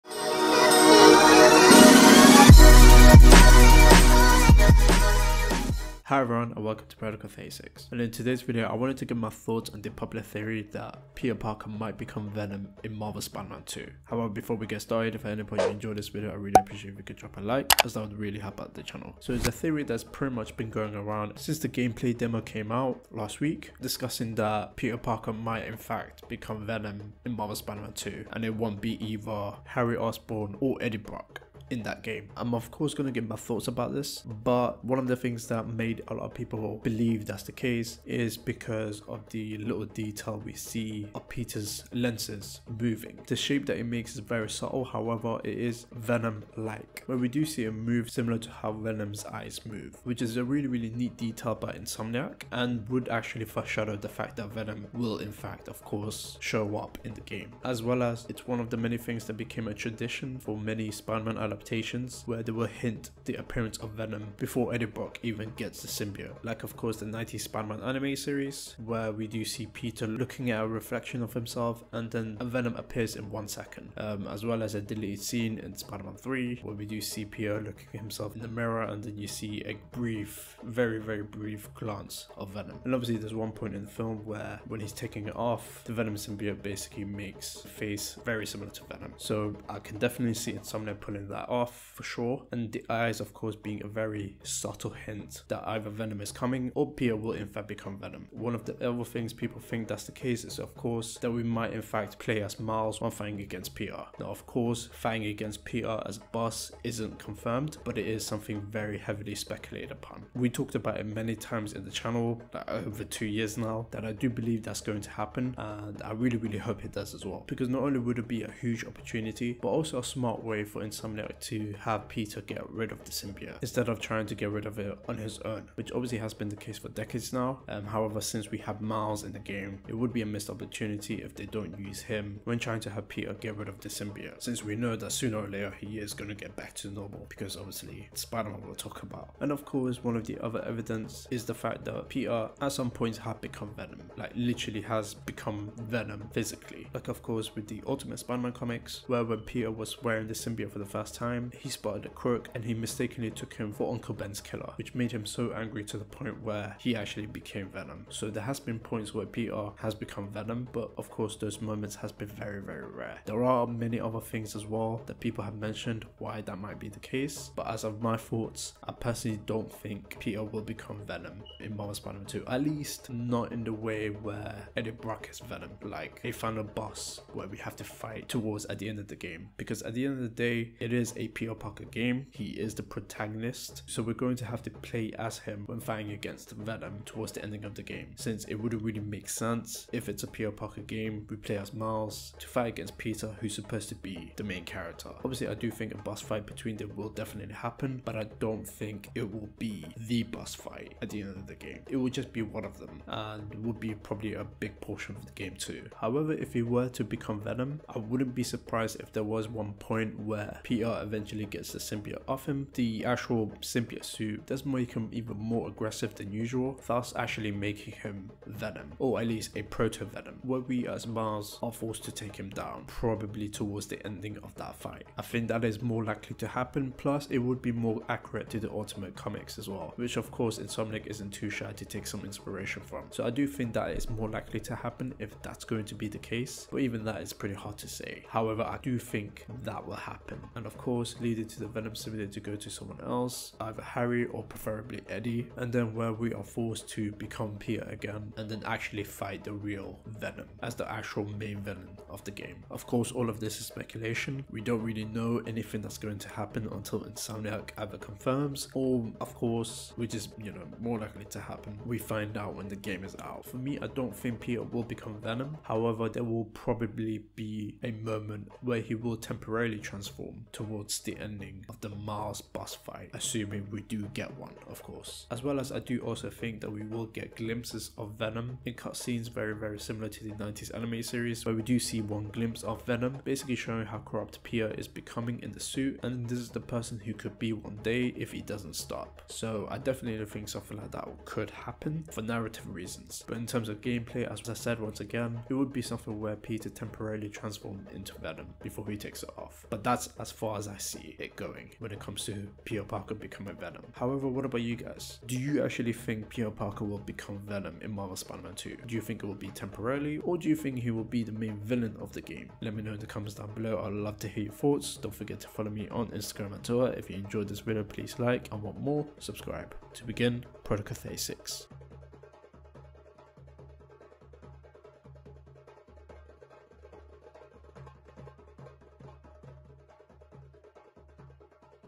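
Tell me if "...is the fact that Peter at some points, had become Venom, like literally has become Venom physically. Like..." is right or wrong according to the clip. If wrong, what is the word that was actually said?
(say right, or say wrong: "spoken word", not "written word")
right.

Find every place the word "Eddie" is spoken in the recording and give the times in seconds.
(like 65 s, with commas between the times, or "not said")
30 s, 64 s, 174 s, 245 s.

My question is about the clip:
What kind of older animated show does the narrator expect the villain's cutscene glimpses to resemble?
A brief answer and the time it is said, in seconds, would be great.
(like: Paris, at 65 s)
90s anime series, at 280 s.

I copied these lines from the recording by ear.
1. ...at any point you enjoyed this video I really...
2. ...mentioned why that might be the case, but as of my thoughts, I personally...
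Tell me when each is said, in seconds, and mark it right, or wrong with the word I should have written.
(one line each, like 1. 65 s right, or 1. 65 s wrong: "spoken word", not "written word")
1. 15 s right
2. 165 s right.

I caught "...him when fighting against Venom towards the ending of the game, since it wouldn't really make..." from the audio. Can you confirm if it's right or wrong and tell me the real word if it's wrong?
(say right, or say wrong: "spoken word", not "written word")
right.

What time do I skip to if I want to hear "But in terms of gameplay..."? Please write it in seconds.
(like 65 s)
293 s.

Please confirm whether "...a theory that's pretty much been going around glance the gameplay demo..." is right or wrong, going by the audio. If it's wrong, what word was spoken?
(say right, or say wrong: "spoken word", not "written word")
wrong: "since", not "glance".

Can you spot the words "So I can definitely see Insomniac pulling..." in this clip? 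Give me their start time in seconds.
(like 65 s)
89 s.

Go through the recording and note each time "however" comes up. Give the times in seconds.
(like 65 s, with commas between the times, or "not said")
14 s, 44 s, 127 s, 205 s, 238 s, 265 s, 303 s.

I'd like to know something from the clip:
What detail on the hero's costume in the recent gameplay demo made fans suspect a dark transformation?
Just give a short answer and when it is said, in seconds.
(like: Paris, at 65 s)
Peter's lenses moving, at 41 s.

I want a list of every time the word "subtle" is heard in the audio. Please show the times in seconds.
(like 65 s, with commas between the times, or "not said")
44 s, 94 s.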